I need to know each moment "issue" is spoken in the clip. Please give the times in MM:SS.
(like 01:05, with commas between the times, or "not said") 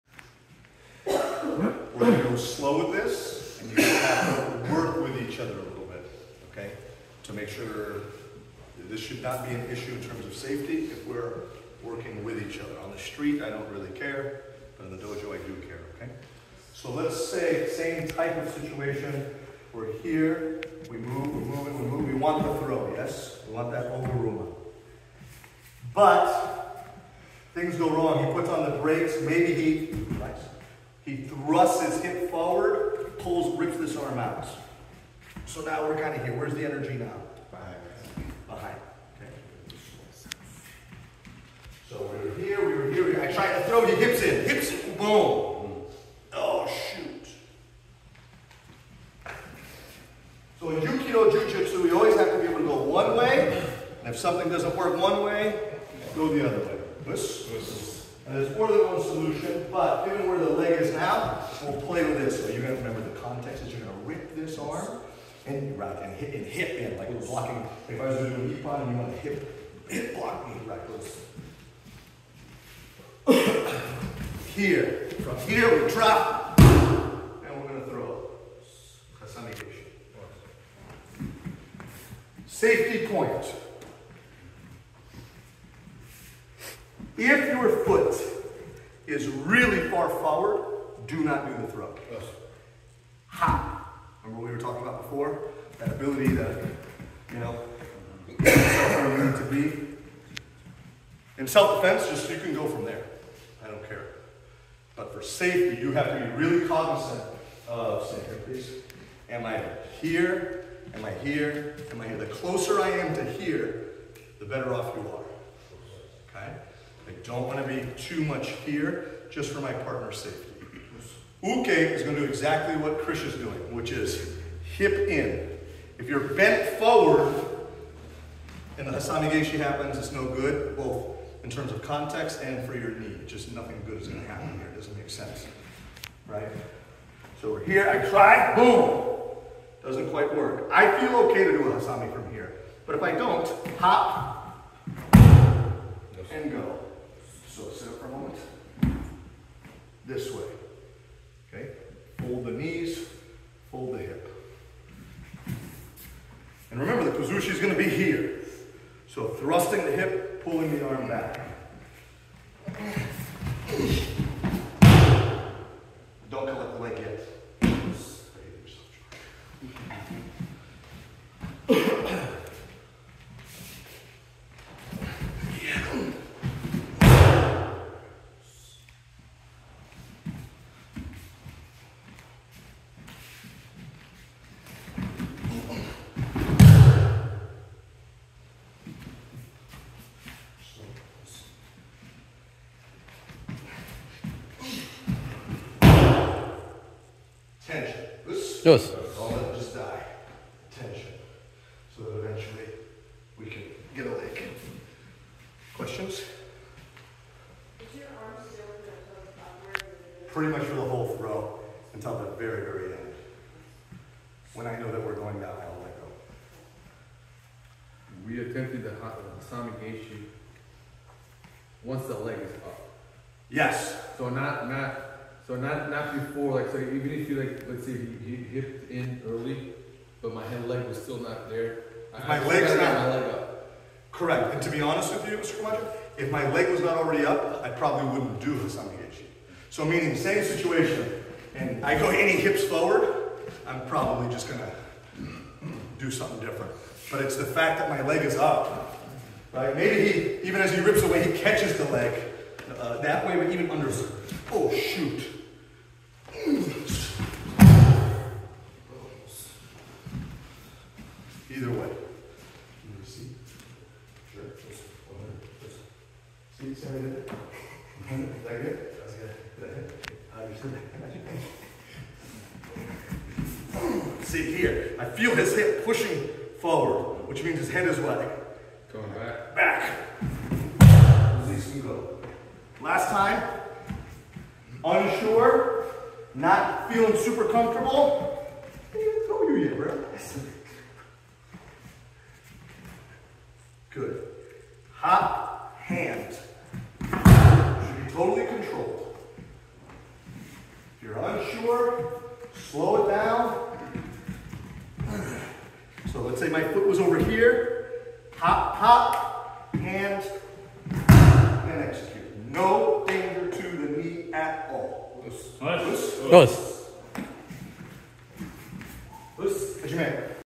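00:09, 03:59.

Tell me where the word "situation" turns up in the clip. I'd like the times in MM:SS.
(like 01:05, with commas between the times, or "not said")
00:18, 04:00.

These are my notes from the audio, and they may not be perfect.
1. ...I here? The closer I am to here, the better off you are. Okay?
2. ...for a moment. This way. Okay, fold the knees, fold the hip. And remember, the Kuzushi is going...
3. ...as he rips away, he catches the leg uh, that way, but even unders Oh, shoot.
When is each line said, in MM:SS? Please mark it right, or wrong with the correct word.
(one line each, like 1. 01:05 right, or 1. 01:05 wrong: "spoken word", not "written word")
1. 01:52 right
2. 02:27 right
3. 04:10 right.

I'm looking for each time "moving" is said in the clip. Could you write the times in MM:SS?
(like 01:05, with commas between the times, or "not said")
00:21.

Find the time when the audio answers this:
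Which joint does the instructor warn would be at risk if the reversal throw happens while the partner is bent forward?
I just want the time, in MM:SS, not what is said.
02:12.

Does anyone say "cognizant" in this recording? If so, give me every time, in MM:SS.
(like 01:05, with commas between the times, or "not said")
01:46.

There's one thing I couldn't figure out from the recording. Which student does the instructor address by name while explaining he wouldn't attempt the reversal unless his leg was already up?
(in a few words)
Mr. Camacho.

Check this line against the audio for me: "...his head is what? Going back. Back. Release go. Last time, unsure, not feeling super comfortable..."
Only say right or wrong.
right.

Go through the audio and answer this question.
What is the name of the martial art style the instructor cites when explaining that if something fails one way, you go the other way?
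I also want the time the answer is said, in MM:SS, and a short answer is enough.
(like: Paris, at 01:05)
Jukido Jitsu, at 00:50.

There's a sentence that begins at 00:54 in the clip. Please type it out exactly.
And if something doesn't work one way, go the other way.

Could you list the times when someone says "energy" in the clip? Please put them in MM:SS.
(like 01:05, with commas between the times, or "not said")
00:36.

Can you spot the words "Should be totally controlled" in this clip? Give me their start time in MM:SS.
04:57.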